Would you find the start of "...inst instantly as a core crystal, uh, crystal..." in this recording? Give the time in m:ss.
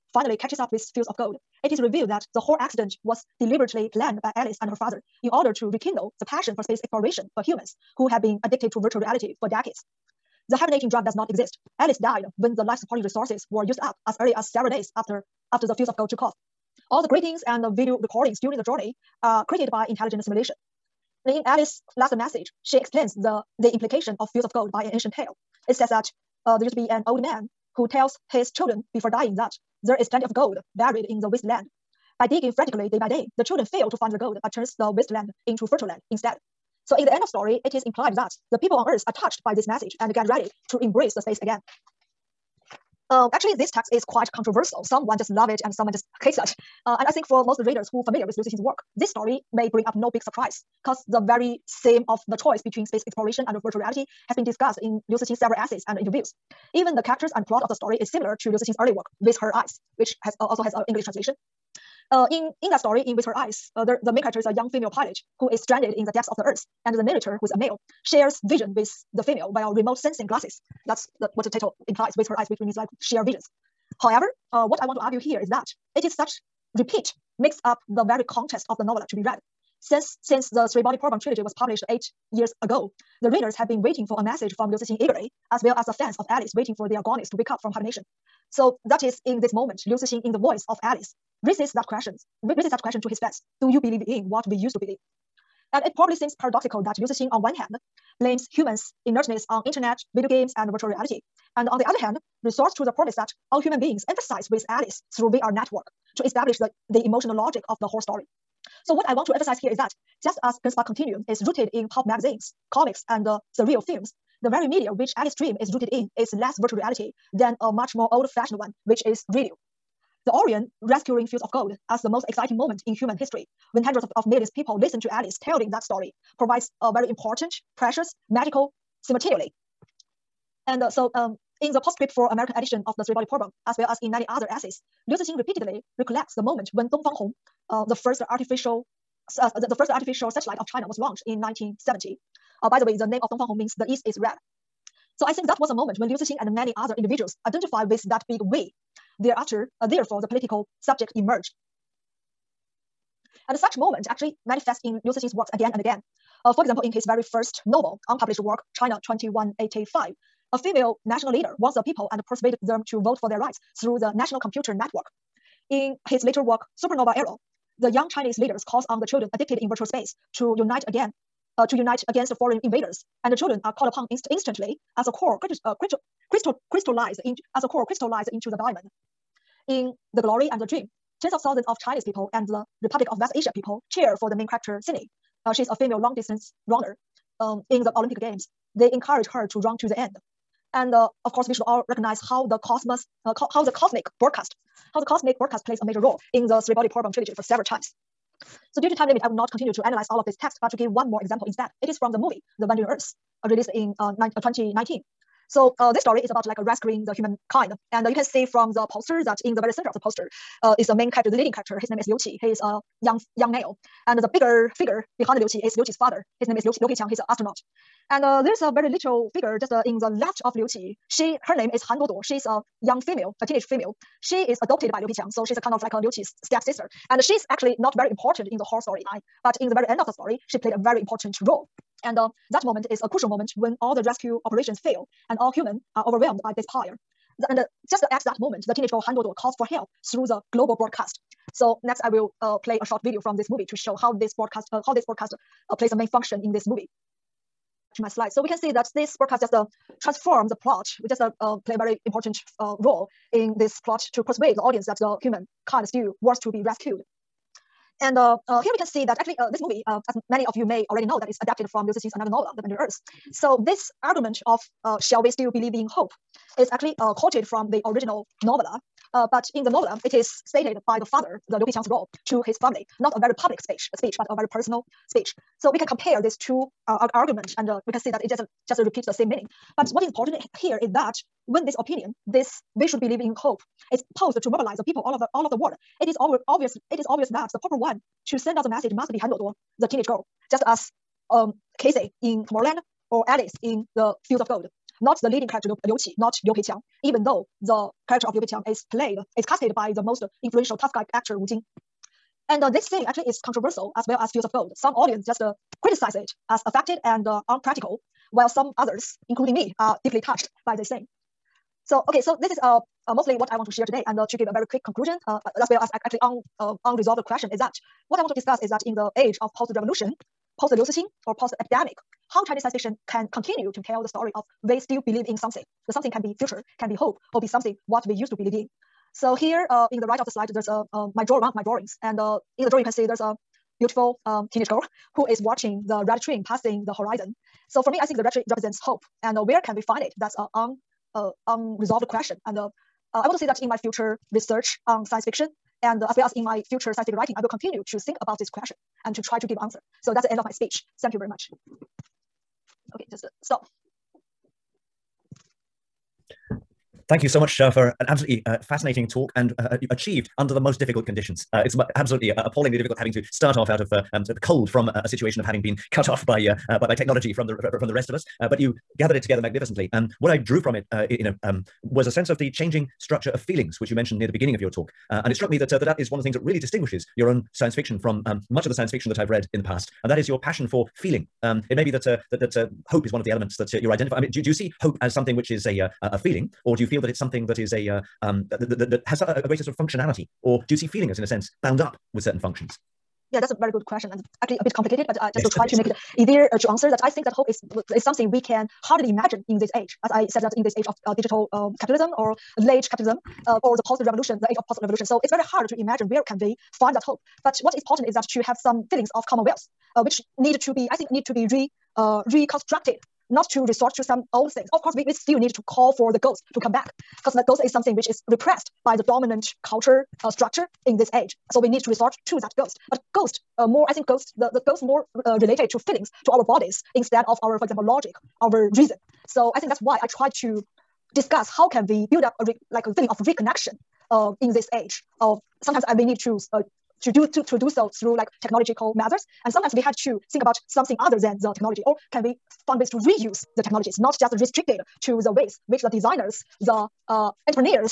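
2:54.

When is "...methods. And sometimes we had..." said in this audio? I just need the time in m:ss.
7:18.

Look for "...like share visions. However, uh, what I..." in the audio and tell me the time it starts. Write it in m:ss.
1:12.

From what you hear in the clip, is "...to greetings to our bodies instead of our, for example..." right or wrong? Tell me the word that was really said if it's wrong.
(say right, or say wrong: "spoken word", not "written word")
wrong: "feelings", not "greetings".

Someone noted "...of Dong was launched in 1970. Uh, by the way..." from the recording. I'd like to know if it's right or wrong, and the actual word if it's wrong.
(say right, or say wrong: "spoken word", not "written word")
wrong: "China", not "Dong".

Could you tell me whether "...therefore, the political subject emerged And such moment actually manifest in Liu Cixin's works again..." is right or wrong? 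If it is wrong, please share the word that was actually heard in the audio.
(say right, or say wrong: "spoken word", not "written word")
right.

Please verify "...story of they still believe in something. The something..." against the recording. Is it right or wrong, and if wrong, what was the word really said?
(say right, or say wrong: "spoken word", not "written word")
right.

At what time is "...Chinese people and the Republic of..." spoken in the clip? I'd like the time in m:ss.
3:01.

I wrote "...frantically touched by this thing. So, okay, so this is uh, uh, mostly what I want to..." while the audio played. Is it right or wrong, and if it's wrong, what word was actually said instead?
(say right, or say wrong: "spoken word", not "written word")
wrong: "deeply", not "frantically".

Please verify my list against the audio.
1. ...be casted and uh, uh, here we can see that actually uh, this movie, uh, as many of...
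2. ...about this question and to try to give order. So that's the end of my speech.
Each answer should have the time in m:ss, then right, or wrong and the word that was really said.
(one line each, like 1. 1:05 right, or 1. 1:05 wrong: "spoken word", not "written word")
1. 4:16 wrong: "rescued", not "casted"
2. 5:48 wrong: "answer", not "order".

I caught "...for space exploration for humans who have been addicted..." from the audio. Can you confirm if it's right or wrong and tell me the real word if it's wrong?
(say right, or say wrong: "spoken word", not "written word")
right.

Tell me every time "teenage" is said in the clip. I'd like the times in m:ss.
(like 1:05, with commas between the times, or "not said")
3:43, 3:58, 4:49, 5:34.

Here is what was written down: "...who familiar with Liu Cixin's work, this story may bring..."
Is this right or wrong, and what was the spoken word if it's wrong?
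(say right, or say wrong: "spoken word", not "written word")
right.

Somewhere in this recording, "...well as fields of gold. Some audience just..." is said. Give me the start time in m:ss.
5:04.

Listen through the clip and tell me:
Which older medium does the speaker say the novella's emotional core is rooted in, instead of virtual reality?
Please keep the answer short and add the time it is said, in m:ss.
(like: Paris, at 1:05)
Radio, at 1:59.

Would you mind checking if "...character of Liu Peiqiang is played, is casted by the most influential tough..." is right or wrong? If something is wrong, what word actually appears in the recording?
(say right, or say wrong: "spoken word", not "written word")
right.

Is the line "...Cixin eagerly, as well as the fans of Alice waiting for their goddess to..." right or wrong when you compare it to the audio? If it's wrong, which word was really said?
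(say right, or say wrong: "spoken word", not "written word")
right.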